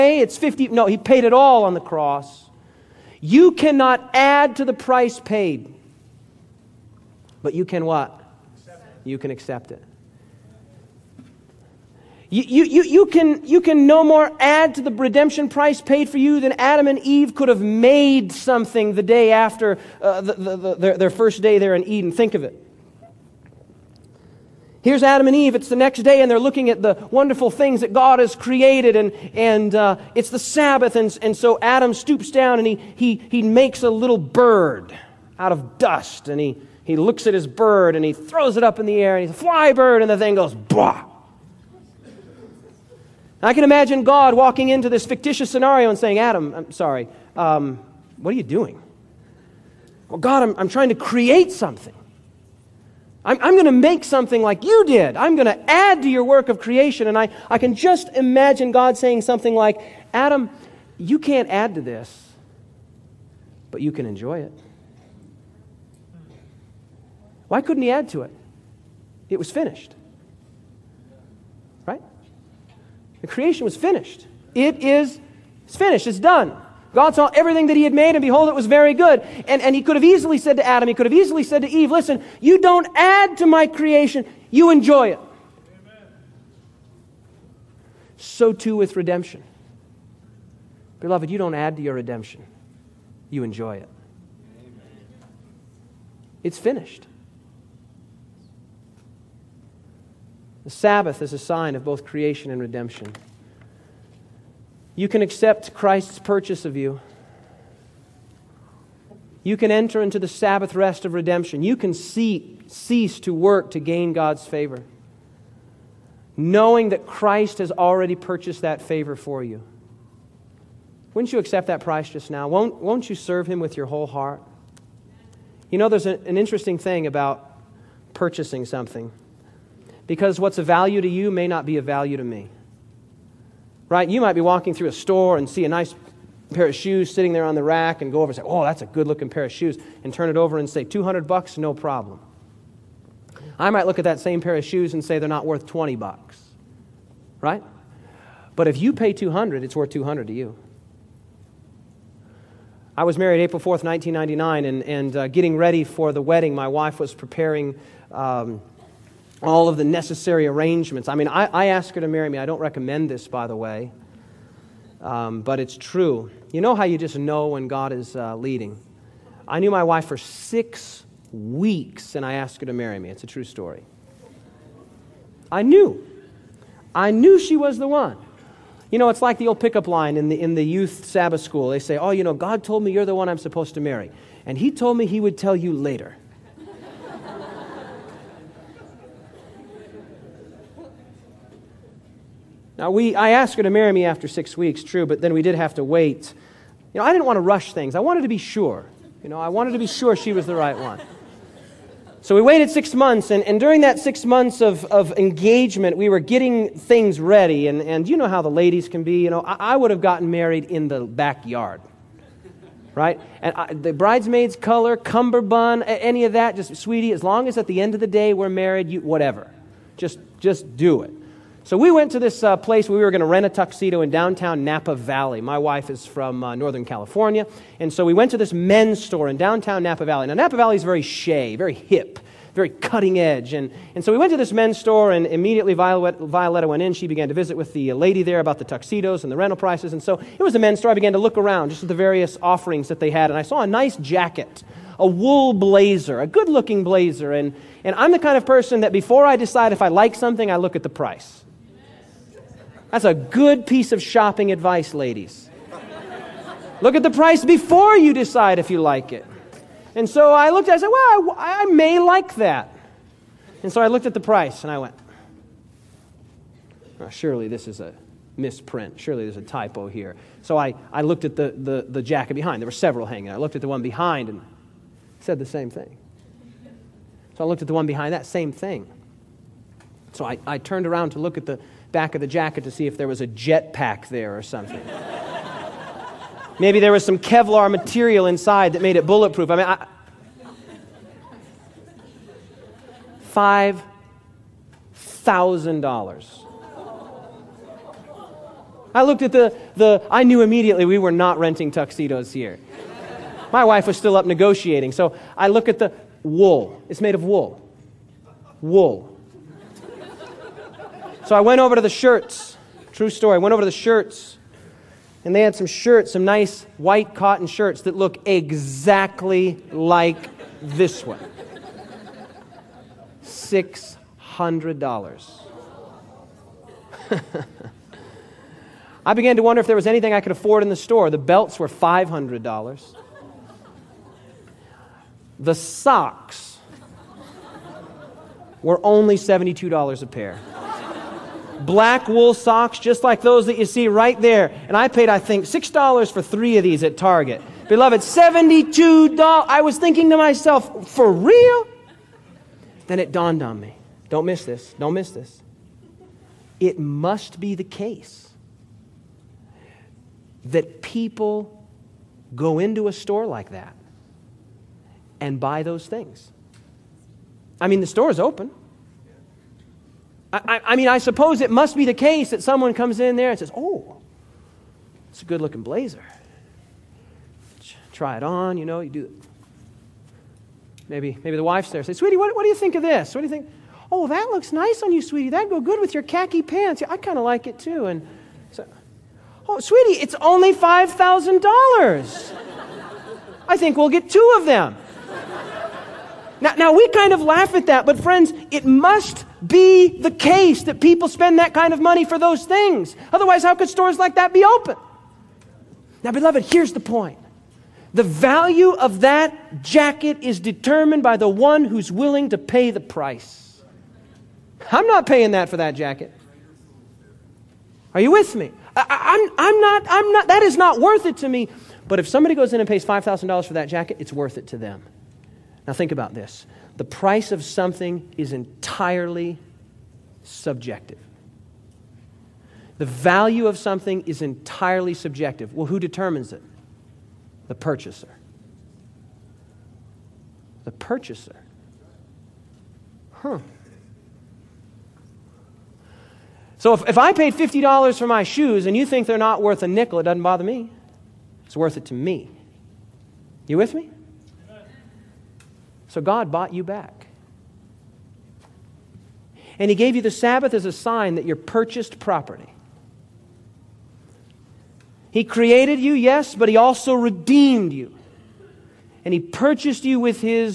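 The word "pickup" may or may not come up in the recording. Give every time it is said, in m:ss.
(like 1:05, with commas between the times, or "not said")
2:59.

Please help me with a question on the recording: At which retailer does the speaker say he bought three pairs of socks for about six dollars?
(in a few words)
Target.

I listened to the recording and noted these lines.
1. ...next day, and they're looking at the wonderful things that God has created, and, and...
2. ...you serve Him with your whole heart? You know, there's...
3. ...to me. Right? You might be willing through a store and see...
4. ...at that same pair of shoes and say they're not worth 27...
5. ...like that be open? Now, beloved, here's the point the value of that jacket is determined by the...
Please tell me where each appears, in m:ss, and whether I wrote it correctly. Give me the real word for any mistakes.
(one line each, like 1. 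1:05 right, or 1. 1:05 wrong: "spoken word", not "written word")
1. 0:25 right
2. 2:03 right
3. 2:12 wrong: "walking", not "willing"
4. 2:23 wrong: "20", not "27"
5. 6:43 right.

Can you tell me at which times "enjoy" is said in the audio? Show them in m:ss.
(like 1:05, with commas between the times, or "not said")
1:04, 1:24, 1:33.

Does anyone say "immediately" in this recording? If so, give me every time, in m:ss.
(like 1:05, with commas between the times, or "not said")
3:55, 5:00.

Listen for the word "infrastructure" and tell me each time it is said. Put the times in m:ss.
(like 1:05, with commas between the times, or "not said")
not said.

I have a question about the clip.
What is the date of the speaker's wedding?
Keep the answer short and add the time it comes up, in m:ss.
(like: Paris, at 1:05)
April 4th, 1999, at 2:33.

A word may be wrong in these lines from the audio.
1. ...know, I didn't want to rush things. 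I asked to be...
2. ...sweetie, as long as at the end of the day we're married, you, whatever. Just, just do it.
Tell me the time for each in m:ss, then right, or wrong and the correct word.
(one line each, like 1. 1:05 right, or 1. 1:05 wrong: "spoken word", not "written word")
1. 3:16 wrong: "wanted", not "asked"
2. 3:36 right.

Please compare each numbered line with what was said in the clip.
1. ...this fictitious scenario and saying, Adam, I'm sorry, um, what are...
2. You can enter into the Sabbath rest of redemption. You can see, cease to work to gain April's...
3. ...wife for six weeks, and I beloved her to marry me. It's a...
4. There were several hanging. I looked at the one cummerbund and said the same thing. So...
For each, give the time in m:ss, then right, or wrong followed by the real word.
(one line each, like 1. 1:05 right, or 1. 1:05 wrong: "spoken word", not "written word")
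1. 0:44 right
2. 1:49 wrong: "God", not "April"
3. 2:49 wrong: "asked", not "beloved"
4. 4:32 wrong: "behind", not "cummerbund".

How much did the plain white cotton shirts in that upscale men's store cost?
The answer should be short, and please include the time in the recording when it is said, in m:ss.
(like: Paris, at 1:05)
$600, at 5:23.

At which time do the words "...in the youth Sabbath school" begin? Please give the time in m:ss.
3:00.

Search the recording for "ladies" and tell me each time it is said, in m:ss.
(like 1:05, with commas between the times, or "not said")
3:28, 4:14.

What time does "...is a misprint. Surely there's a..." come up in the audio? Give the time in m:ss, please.
4:27.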